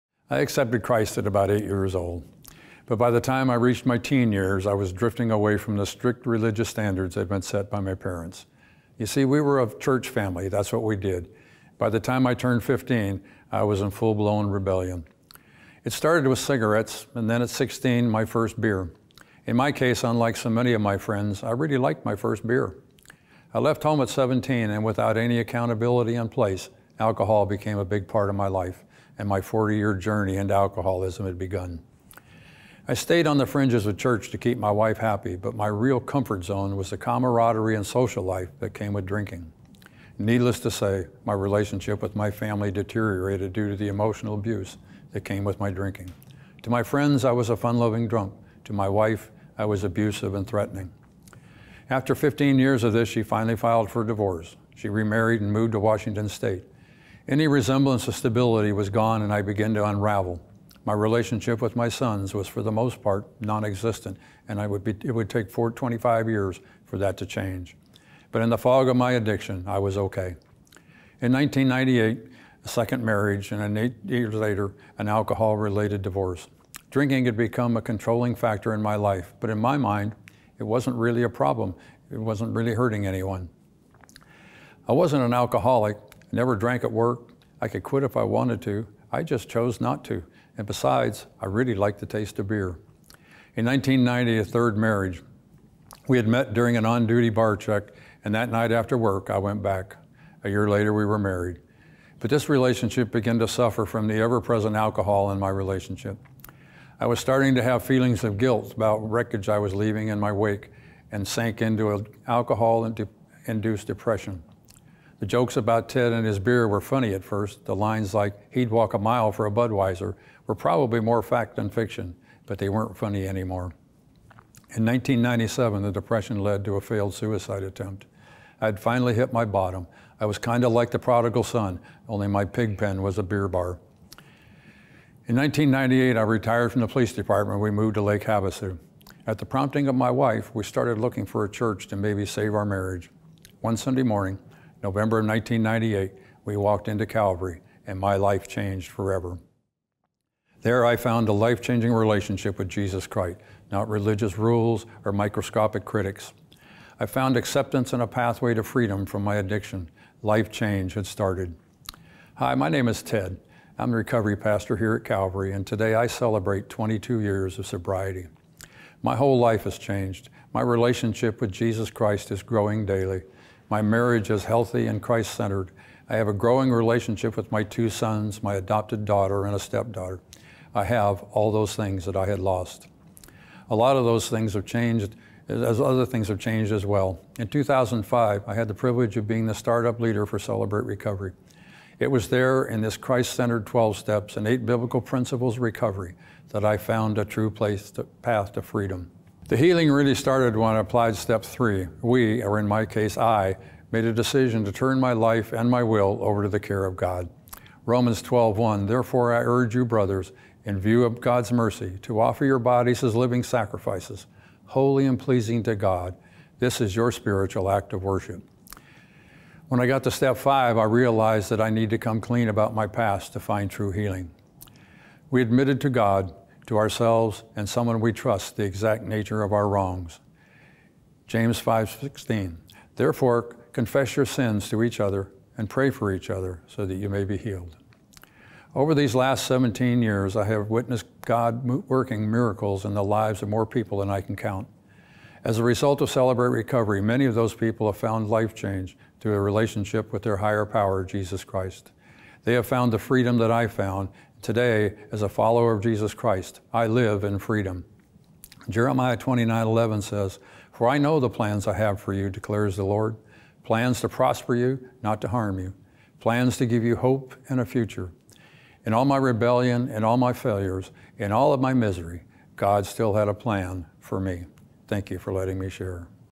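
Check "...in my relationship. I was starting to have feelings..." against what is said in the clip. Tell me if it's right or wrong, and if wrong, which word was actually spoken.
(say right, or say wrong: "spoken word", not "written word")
right.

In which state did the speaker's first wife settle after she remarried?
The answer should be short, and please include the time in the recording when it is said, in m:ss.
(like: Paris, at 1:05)
Washington, at 0:55.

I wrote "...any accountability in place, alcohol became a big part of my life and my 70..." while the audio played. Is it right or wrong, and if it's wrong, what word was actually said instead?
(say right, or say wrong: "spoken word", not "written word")
wrong: "40", not "70".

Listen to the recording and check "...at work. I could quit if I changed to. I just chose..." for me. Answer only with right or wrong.
wrong.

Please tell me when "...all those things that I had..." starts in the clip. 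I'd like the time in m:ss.
3:01.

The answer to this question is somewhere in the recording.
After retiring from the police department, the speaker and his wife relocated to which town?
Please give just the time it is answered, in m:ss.
2:18.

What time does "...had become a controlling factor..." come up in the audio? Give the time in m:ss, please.
1:17.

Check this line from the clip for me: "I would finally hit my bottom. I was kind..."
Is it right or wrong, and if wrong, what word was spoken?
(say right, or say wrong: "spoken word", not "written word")
right.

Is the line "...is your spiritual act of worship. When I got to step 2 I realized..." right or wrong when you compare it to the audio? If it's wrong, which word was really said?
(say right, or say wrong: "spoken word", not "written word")
wrong: "5", not "2".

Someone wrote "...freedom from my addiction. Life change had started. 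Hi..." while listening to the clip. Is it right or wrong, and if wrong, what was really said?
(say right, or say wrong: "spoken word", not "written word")
right.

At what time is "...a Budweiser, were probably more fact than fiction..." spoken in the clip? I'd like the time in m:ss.
1:59.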